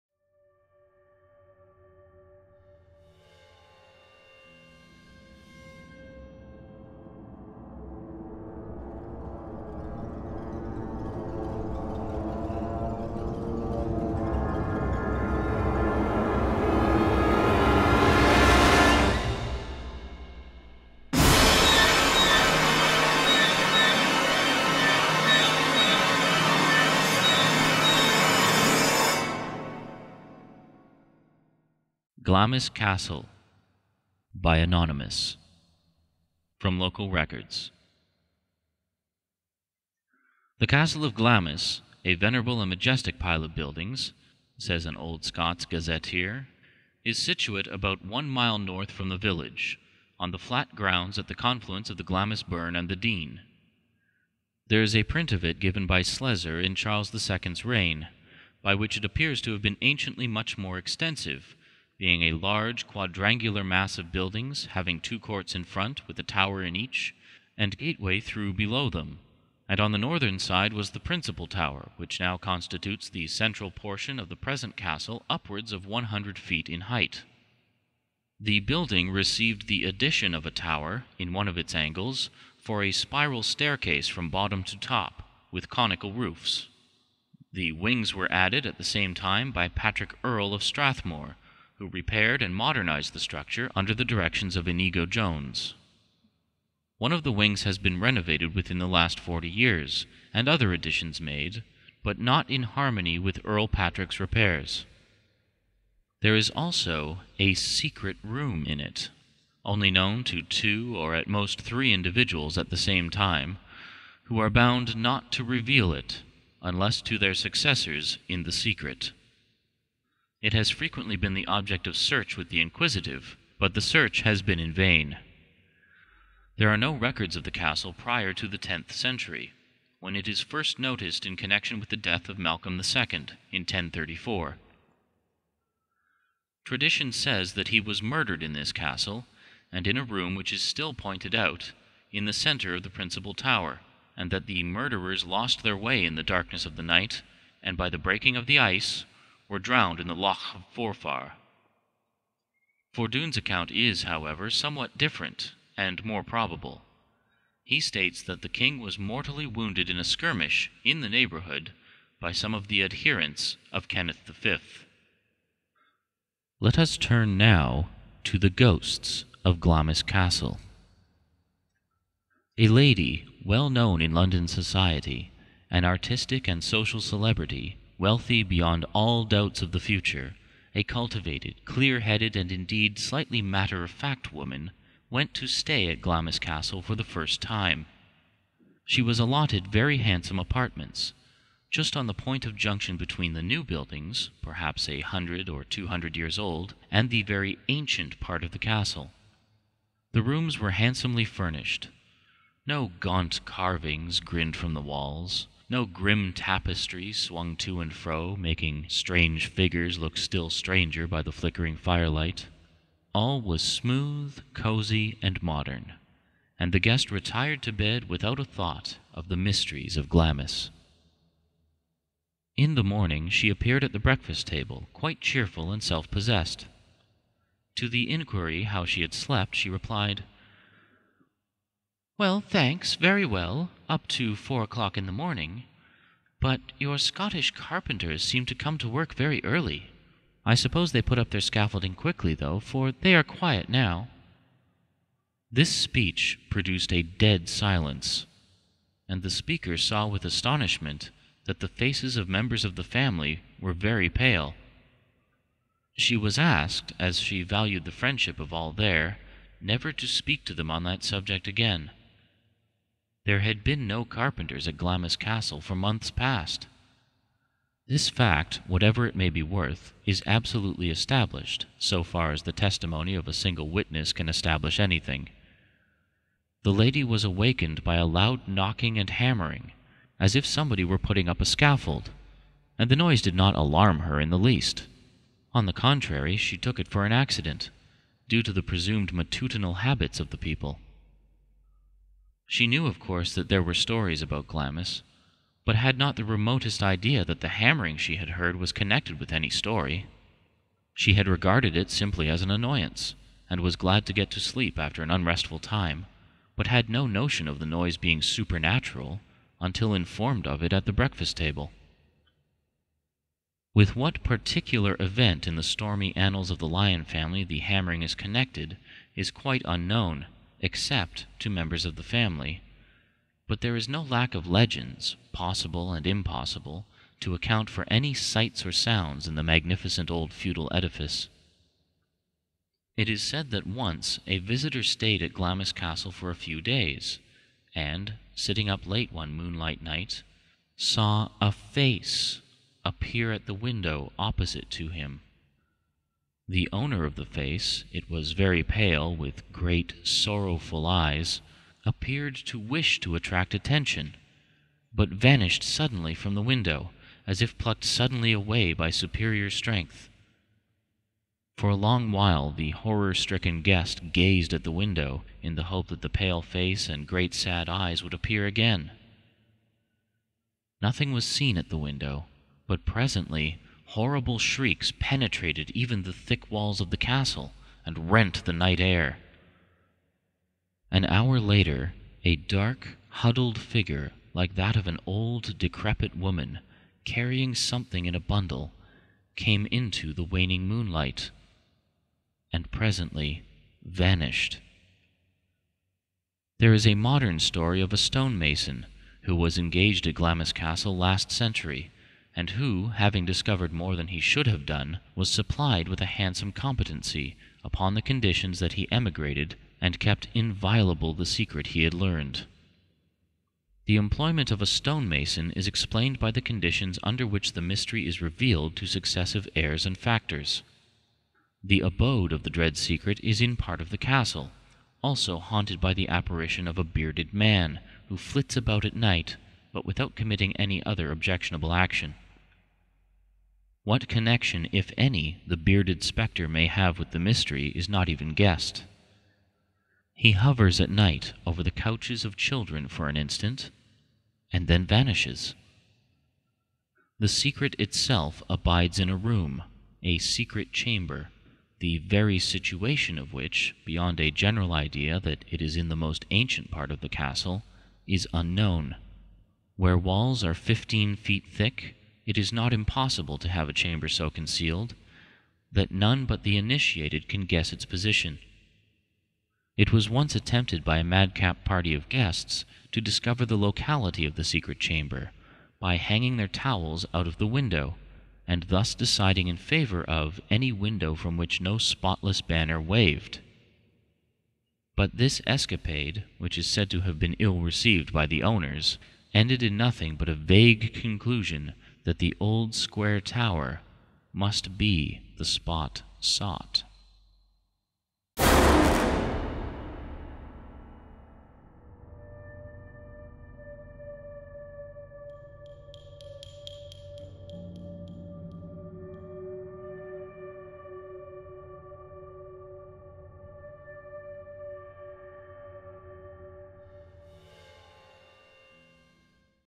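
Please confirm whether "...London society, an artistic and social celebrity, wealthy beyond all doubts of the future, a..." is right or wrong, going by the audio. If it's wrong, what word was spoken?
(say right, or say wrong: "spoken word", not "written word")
right.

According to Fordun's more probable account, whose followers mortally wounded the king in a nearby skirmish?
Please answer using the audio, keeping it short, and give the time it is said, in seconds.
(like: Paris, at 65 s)
Kenneth V, at 163 s.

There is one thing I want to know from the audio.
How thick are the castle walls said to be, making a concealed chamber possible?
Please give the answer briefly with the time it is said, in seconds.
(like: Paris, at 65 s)
15 feet, at 460 s.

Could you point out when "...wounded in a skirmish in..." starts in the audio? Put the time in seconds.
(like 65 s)
159 s.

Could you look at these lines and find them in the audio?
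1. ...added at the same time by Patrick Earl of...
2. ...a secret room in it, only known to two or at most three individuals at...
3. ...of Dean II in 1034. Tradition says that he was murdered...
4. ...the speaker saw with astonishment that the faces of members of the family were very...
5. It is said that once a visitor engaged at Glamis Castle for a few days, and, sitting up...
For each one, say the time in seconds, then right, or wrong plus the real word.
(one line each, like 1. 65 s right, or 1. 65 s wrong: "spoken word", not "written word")
1. 88 s right
2. 107 s right
3. 132 s wrong: "Malcolm", not "Dean"
4. 249 s right
5. 332 s wrong: "stayed", not "engaged".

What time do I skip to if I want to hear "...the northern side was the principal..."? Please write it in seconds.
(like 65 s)
69 s.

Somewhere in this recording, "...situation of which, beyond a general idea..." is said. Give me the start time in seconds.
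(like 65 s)
452 s.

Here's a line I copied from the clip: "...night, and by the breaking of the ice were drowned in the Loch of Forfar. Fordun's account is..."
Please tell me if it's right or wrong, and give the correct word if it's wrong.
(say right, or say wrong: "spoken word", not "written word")
right.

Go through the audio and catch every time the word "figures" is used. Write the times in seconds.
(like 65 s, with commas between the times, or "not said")
209 s, 383 s.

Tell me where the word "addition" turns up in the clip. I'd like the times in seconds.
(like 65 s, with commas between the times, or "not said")
79 s, 100 s.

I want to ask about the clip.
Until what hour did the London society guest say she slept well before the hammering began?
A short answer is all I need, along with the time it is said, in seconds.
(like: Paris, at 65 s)
4 o'clock, at 234 s.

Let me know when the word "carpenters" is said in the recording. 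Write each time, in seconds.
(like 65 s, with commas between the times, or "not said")
237 s, 264 s.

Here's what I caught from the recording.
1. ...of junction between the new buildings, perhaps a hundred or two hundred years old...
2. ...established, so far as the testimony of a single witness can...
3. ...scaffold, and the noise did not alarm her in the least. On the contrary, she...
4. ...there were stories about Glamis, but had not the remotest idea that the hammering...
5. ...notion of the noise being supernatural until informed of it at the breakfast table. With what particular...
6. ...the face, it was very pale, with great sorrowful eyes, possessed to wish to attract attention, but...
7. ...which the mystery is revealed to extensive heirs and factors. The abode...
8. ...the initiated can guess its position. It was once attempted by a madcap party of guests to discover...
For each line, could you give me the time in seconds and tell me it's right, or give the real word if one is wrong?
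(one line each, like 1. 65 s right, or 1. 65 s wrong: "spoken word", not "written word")
1. 192 s right
2. 270 s right
3. 281 s right
4. 293 s right
5. 307 s right
6. 347 s wrong: "appeared", not "possessed"
7. 417 s wrong: "successive", not "extensive"
8. 466 s right.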